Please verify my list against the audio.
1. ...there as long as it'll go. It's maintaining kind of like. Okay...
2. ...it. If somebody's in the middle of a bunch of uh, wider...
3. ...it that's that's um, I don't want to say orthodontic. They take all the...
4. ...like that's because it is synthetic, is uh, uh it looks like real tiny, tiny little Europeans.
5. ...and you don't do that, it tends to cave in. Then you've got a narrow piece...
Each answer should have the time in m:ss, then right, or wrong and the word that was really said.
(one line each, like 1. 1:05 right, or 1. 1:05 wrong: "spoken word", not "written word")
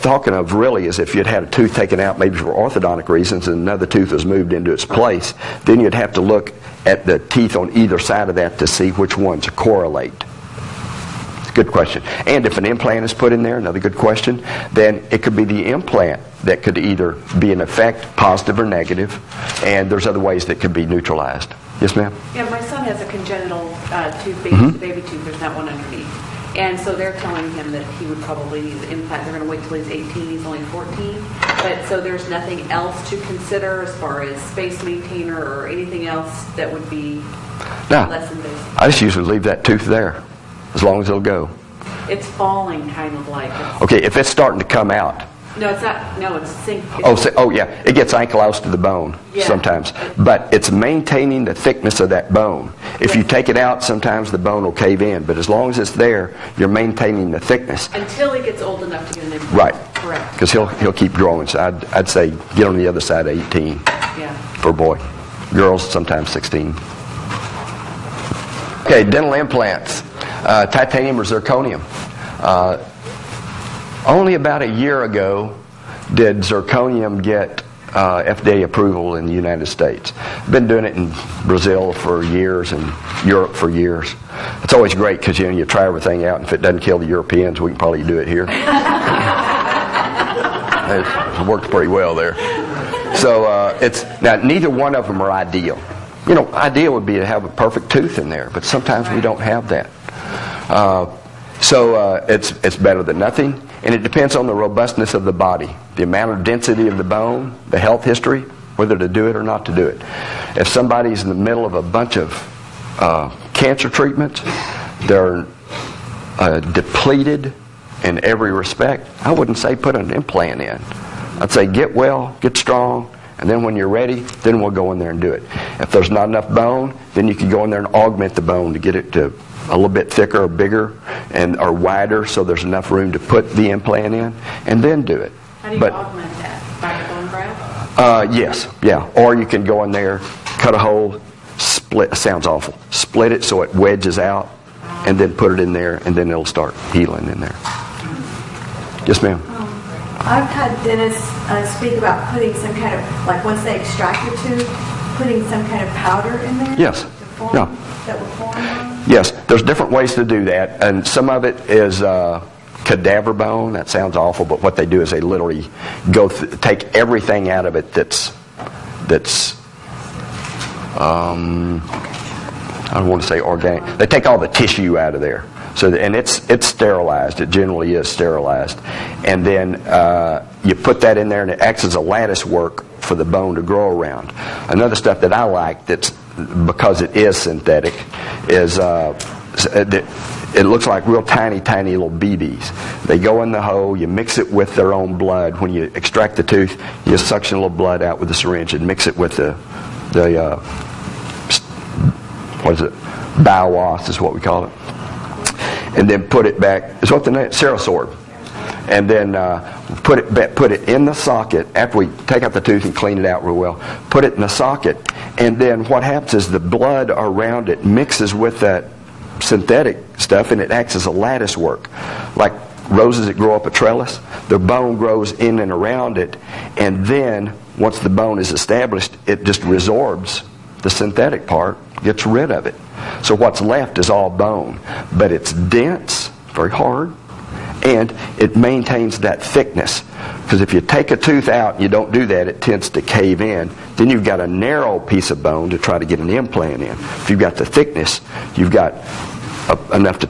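1. 0:39 wrong: "falling", not "maintaining"
2. 1:49 wrong: "cancer", not "wider"
3. 2:47 wrong: "organic", not "orthodontic"
4. 3:05 wrong: "BBs", not "Europeans"
5. 4:01 right.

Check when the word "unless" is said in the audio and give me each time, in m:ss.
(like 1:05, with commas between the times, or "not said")
not said.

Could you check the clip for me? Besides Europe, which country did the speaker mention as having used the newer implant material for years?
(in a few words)
Brazil.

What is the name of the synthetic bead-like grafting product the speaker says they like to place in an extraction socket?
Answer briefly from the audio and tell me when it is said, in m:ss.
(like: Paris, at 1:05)
Cerasorb, at 3:27.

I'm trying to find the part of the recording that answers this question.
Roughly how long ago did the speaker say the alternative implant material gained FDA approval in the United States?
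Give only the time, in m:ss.
1:14.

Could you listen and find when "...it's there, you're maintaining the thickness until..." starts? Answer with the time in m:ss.
0:55.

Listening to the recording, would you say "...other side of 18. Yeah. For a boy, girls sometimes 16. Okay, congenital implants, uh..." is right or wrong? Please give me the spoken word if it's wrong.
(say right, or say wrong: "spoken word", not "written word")
wrong: "dental", not "congenital".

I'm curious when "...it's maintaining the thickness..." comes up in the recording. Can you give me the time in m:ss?
0:50.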